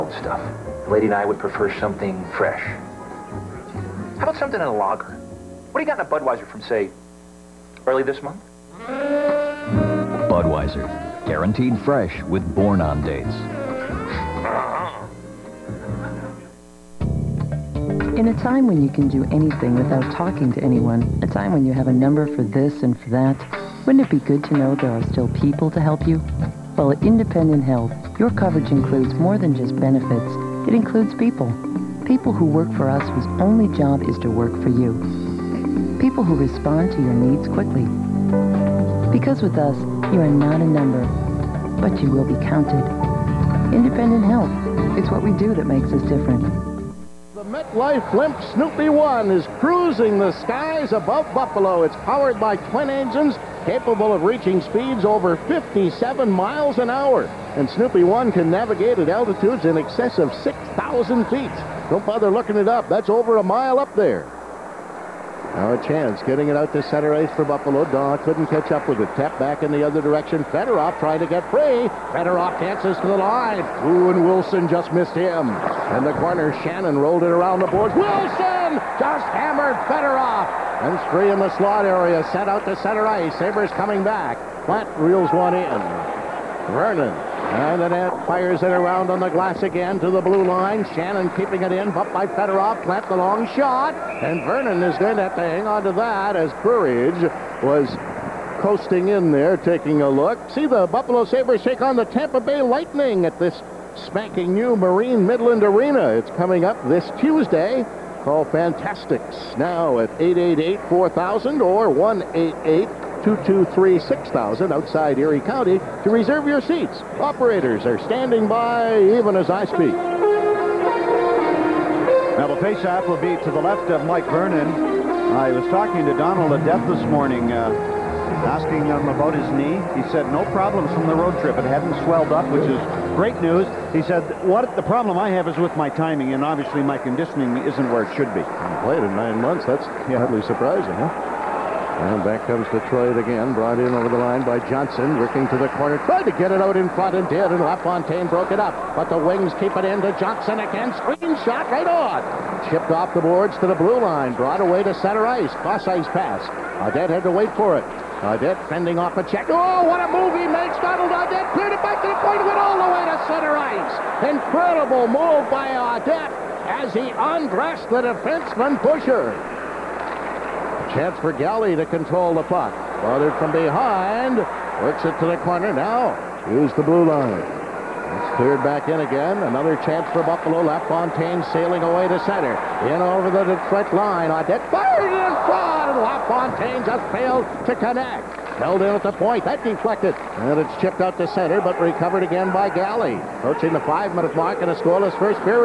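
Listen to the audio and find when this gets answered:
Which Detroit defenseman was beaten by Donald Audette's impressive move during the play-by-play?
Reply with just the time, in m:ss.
2:48.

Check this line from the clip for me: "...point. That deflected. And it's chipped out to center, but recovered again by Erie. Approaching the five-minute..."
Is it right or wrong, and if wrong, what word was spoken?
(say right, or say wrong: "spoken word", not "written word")
wrong: "Galley", not "Erie".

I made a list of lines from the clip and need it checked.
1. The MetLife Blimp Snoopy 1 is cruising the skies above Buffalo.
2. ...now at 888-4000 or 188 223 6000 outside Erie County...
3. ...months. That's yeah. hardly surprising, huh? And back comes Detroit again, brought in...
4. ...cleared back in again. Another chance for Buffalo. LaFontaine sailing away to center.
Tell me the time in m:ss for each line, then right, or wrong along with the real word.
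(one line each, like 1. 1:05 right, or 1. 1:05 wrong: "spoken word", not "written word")
1. 0:47 right
2. 1:49 right
3. 2:19 right
4. 2:58 right.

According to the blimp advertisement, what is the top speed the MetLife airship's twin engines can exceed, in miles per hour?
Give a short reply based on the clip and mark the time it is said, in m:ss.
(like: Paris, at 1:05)
57, at 0:55.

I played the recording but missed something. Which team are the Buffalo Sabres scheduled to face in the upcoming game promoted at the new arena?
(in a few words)
Tampa Bay Lightning.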